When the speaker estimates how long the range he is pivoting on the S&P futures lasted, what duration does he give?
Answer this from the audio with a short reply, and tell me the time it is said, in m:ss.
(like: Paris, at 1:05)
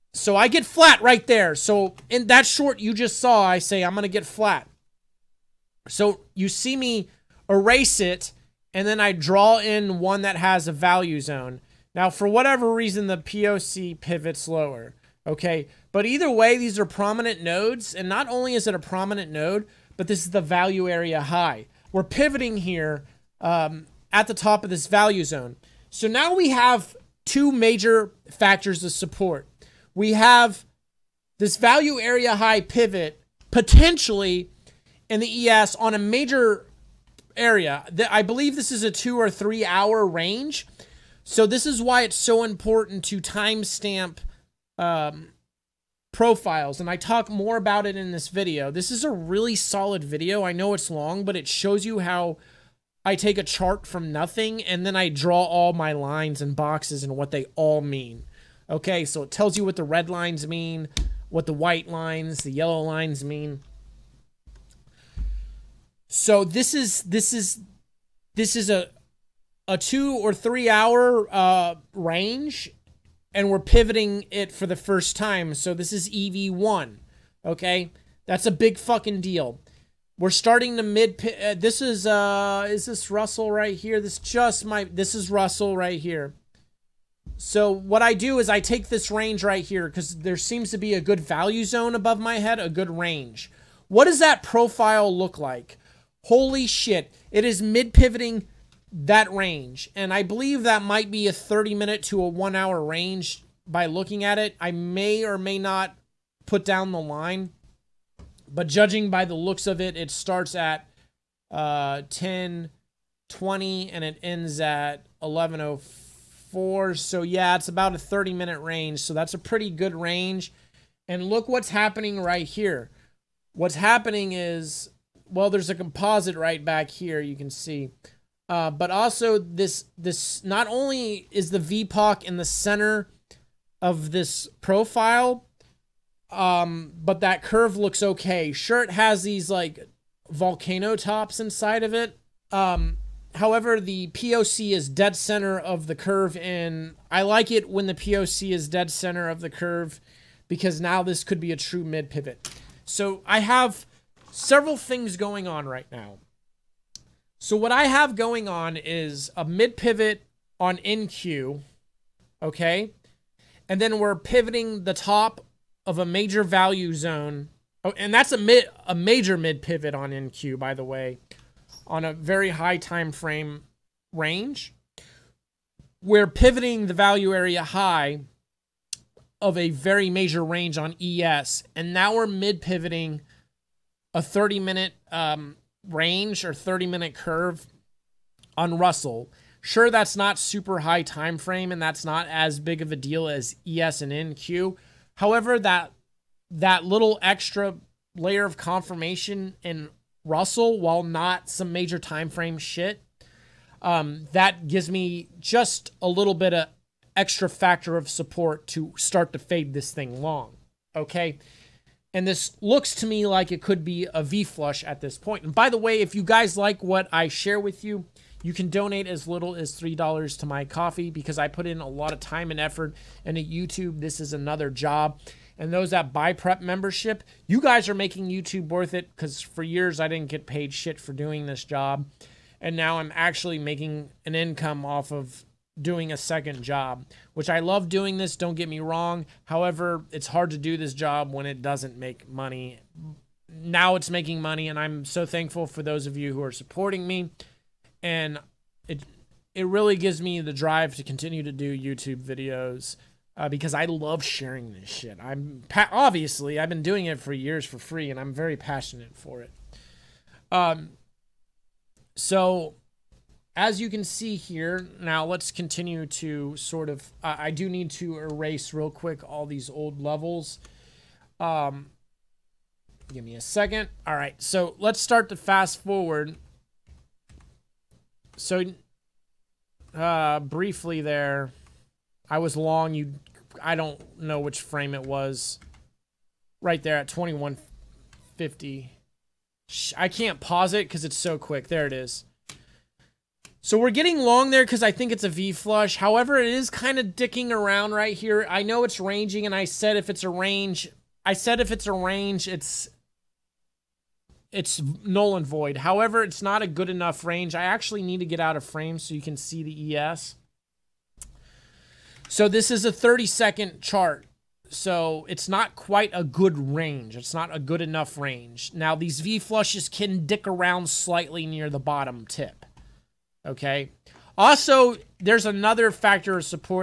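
2 or 3 hours, at 0:38.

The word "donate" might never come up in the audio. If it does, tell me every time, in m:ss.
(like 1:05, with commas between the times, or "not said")
3:38.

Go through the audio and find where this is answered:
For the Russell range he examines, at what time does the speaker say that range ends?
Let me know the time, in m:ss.
1:55.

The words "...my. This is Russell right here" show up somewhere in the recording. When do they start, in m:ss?
1:24.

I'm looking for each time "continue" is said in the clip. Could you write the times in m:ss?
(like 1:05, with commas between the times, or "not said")
4:11, 4:25.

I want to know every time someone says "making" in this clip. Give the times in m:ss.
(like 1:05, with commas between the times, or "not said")
3:47, 3:53, 4:04.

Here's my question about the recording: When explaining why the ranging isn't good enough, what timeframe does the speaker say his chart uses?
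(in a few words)
30 seconds.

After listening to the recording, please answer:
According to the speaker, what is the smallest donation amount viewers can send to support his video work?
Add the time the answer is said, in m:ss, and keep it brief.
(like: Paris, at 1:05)
$3, at 3:39.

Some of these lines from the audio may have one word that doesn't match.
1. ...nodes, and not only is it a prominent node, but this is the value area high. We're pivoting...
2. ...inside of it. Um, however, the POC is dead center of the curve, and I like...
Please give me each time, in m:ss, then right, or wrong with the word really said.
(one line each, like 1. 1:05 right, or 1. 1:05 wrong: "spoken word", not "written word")
1. 0:17 right
2. 2:21 right.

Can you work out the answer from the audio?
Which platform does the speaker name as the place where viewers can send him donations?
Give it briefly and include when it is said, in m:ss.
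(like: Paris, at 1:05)
Ko-fi, at 3:40.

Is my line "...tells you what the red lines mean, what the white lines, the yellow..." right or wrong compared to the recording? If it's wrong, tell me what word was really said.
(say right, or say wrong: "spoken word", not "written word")
right.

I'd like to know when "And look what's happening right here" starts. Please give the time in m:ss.
2:01.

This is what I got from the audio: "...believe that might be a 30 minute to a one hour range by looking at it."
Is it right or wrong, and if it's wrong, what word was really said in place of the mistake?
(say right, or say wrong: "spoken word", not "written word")
right.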